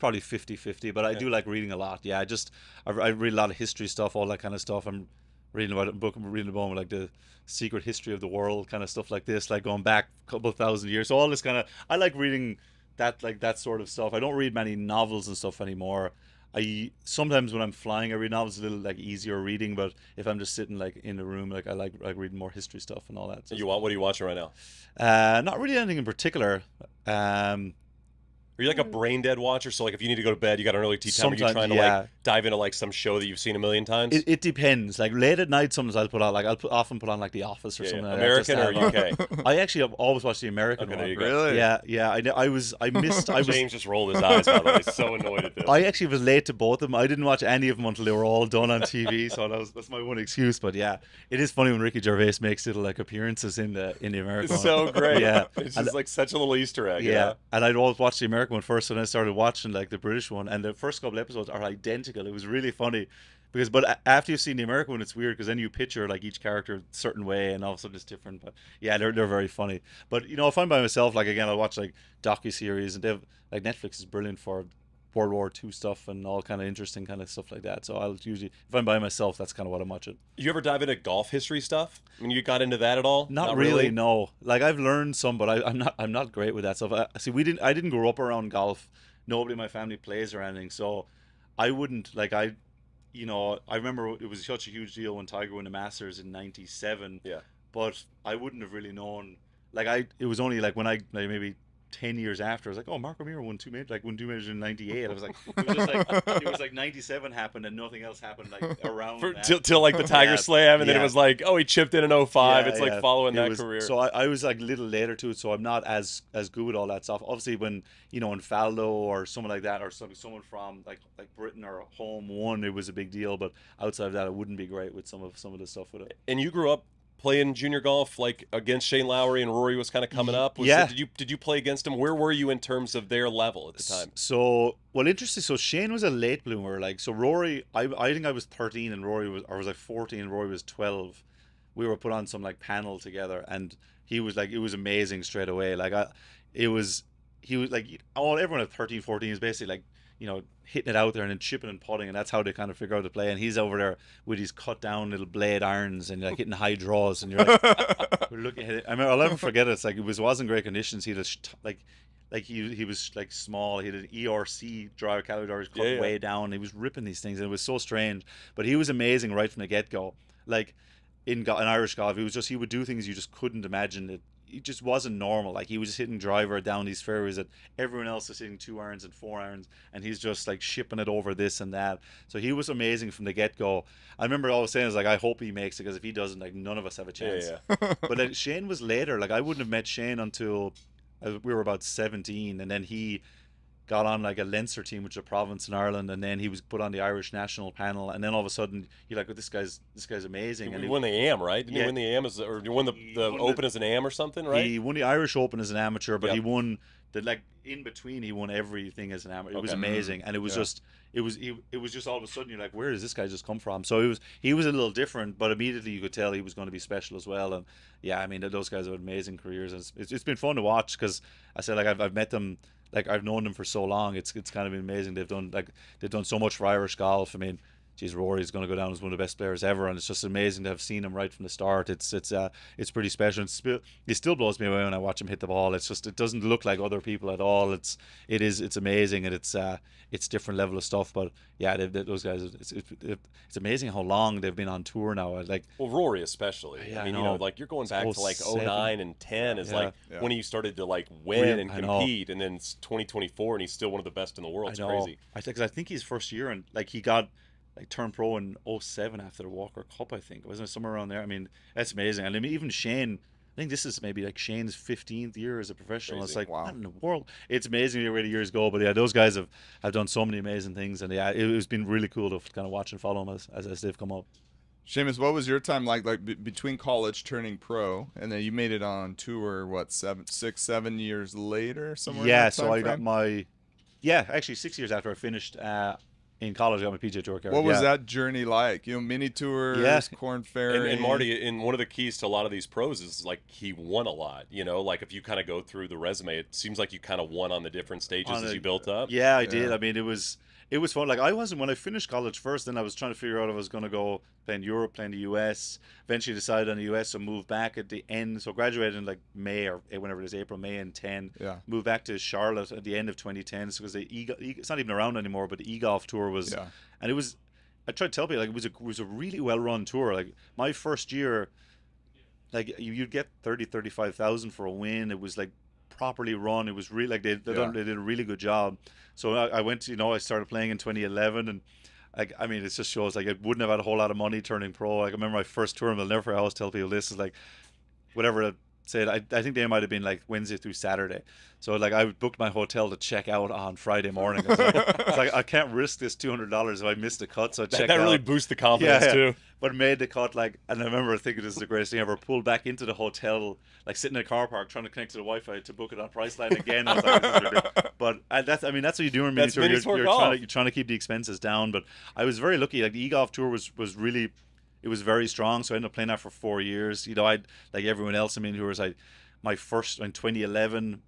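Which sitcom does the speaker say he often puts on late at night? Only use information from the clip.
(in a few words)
The Office.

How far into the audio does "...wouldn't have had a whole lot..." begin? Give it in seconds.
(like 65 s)
333 s.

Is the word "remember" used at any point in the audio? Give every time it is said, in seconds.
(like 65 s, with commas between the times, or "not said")
93 s, 184 s, 335 s, 350 s.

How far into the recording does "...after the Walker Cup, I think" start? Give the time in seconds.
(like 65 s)
259 s.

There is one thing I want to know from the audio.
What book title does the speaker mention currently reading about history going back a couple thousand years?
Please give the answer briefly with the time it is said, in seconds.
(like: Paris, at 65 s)
The Secret History of the World, at 6 s.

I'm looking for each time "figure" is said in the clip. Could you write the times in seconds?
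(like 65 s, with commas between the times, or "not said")
152 s, 303 s.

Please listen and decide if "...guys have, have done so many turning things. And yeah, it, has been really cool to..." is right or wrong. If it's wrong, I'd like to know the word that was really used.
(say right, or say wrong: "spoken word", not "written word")
wrong: "amazing", not "turning".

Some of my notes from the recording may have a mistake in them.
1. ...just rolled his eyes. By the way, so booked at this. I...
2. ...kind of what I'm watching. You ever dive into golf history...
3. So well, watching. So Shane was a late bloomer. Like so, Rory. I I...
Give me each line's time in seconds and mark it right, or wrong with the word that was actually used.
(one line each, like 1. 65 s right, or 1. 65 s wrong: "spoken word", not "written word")
1. 43 s wrong: "annoyed", not "booked"
2. 79 s right
3. 134 s wrong: "interesting", not "watching".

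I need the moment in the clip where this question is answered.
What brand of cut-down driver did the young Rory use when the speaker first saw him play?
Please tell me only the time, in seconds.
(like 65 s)
165 s.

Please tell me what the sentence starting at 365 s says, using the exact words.
So I ended up playing that for four years.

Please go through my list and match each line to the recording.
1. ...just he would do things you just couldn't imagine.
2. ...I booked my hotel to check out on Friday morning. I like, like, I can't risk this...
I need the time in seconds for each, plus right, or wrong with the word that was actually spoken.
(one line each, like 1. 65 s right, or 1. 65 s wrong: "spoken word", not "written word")
1. 172 s right
2. 341 s right.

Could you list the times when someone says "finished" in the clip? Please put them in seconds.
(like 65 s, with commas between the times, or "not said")
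285 s, 301 s.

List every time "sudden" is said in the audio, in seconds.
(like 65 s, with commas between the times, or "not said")
198 s, 212 s.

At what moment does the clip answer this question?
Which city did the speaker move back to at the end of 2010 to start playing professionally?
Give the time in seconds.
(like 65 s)
312 s.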